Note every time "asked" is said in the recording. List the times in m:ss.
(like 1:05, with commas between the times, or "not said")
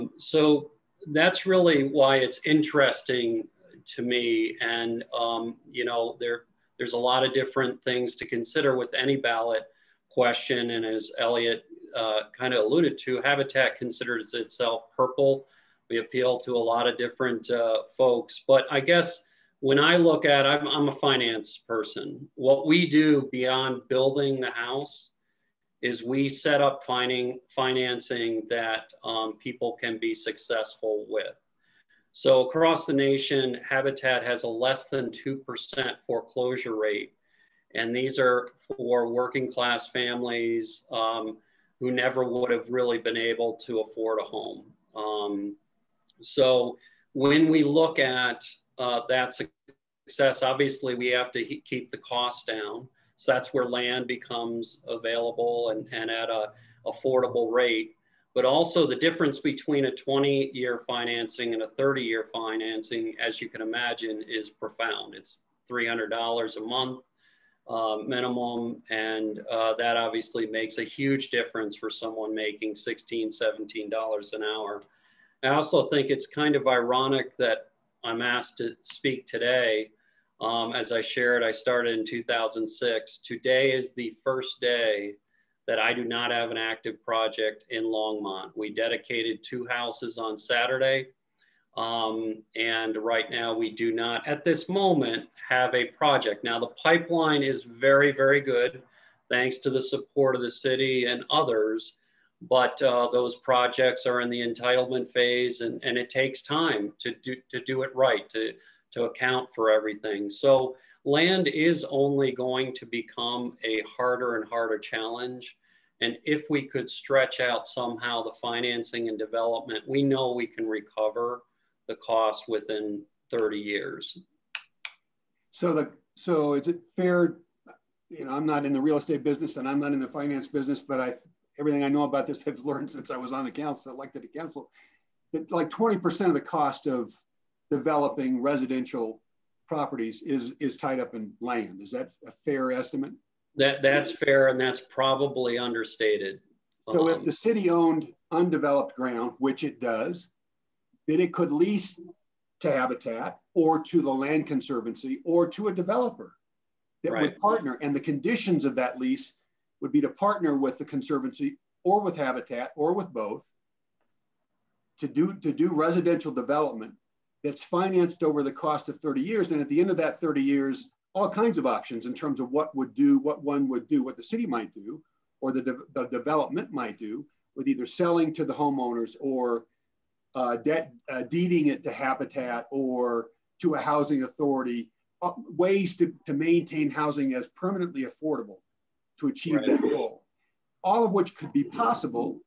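1:18.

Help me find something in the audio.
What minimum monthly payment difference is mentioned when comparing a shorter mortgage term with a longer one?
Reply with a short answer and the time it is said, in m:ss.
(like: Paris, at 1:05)
$300, at 1:05.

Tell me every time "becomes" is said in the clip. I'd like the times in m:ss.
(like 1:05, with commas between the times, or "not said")
0:54, 1:52.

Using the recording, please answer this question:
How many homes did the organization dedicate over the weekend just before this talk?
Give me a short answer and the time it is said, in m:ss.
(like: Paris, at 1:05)
2, at 1:29.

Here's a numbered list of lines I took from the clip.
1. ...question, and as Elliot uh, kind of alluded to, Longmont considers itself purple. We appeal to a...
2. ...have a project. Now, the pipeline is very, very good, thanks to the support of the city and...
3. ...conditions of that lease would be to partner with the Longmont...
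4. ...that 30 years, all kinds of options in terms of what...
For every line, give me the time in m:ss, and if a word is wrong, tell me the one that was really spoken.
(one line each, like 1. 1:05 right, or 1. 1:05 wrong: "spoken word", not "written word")
1. 0:10 wrong: "Habitat", not "Longmont"
2. 1:35 right
3. 2:38 wrong: "Conservancy", not "Longmont"
4. 2:49 right.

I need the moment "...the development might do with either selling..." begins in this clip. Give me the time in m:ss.
2:55.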